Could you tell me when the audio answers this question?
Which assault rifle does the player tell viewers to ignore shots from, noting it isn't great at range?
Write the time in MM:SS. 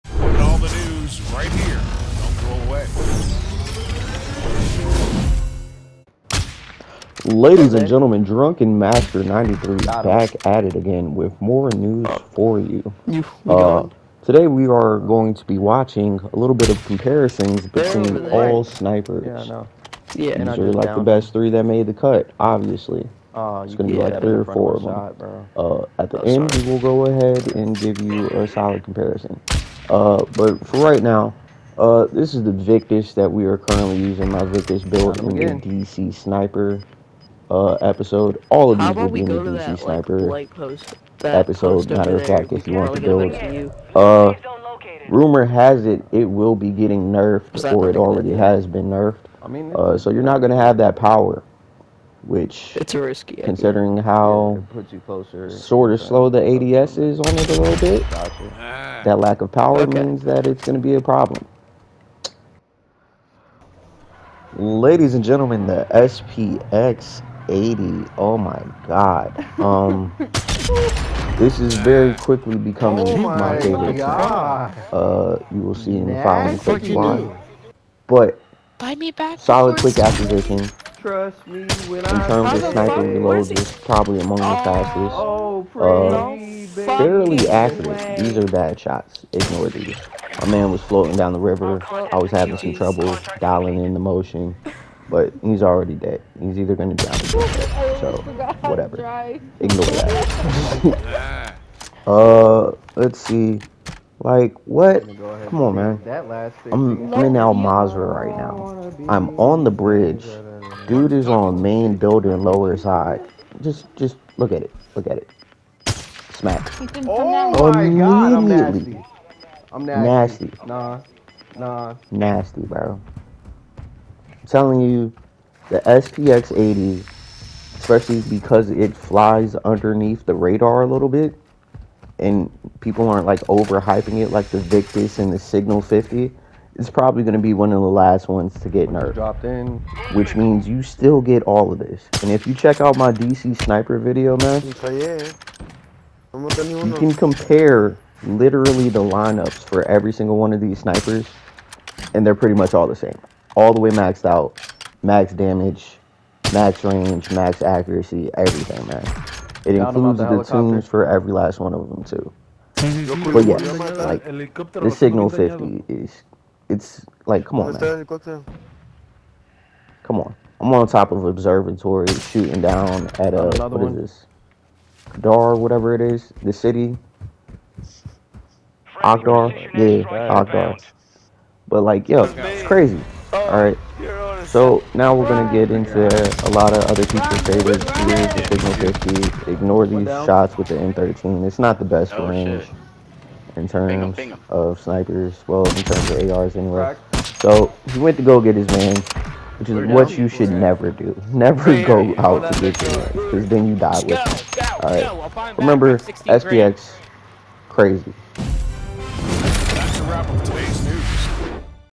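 03:10.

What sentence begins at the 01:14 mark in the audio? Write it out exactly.
Uh, you will see in the following clips But Buy me back solid quick acquisition.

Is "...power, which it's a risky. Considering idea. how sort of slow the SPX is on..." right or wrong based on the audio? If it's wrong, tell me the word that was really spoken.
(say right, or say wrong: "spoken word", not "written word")
wrong: "ADS", not "SPX".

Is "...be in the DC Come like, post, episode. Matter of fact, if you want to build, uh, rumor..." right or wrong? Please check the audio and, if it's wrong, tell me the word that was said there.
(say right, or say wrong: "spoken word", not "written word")
wrong: "Sniper", not "Come".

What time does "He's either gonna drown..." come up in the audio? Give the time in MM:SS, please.
01:36.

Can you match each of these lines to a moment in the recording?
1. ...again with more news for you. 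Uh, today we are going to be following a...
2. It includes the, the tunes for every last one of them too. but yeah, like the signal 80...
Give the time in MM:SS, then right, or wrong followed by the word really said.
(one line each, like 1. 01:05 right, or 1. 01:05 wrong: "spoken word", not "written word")
1. 00:10 wrong: "watching", not "following"
2. 02:39 wrong: "50", not "80".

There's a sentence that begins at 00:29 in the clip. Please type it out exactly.
Uh, but for right now, uh, this is the Victus that we are currently using.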